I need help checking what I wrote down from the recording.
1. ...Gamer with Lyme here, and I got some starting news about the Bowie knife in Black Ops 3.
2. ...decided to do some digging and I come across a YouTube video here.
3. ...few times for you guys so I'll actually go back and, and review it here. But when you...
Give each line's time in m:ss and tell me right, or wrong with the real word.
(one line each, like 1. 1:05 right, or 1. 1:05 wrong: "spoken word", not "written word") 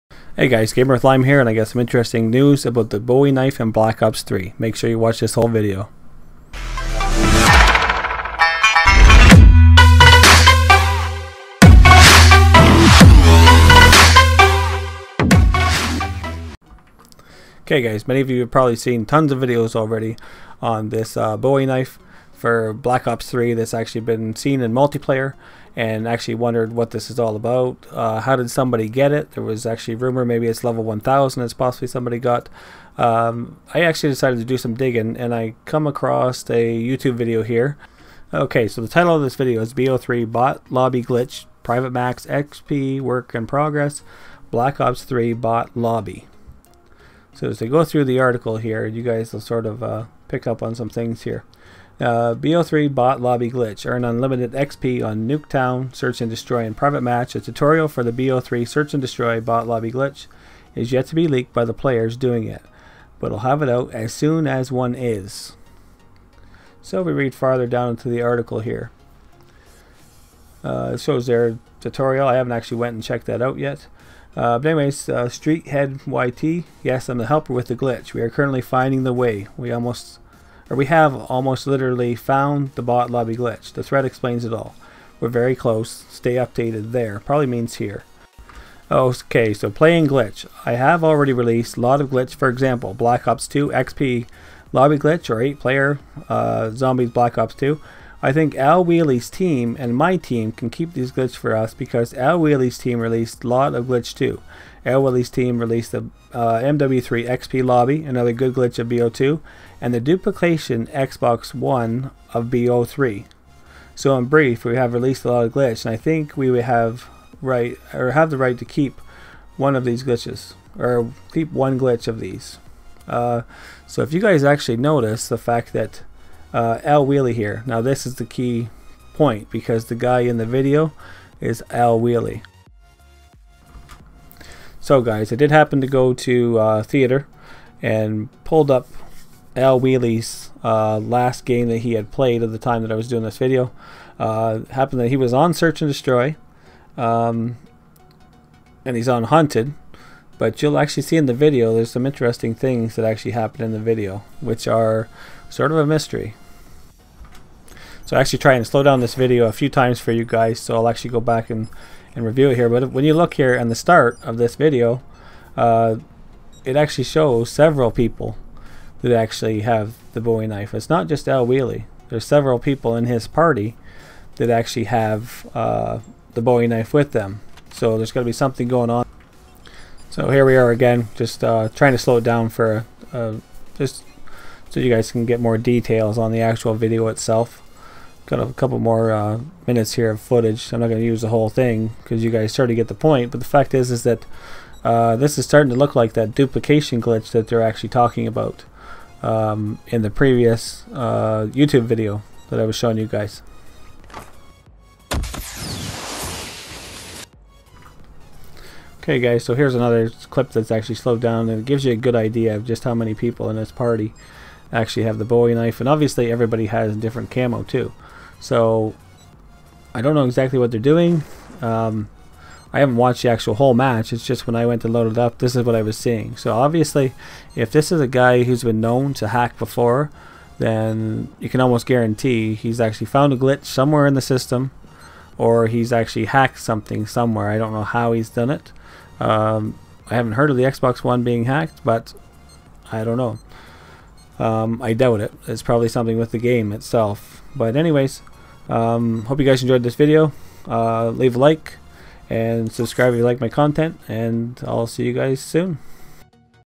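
1. 0:00 wrong: "interesting", not "starting"
2. 0:34 right
3. 2:39 right.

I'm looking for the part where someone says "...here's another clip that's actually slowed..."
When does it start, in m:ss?
3:29.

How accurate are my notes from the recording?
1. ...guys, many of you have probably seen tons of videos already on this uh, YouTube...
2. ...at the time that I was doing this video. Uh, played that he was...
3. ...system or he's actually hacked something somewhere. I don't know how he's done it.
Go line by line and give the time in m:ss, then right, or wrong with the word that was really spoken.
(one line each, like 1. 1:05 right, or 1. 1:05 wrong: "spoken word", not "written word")
1. 0:17 wrong: "Bowie", not "YouTube"
2. 2:22 wrong: "happened", not "played"
3. 3:54 right.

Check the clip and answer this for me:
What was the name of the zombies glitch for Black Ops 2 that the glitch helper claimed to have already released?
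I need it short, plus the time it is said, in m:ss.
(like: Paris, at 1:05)
8 player zombies, at 1:35.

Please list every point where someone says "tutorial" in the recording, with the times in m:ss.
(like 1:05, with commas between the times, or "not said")
0:57, 1:11.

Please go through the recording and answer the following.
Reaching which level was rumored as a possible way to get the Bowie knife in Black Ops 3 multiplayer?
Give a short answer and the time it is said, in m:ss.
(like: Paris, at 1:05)
1000, at 0:30.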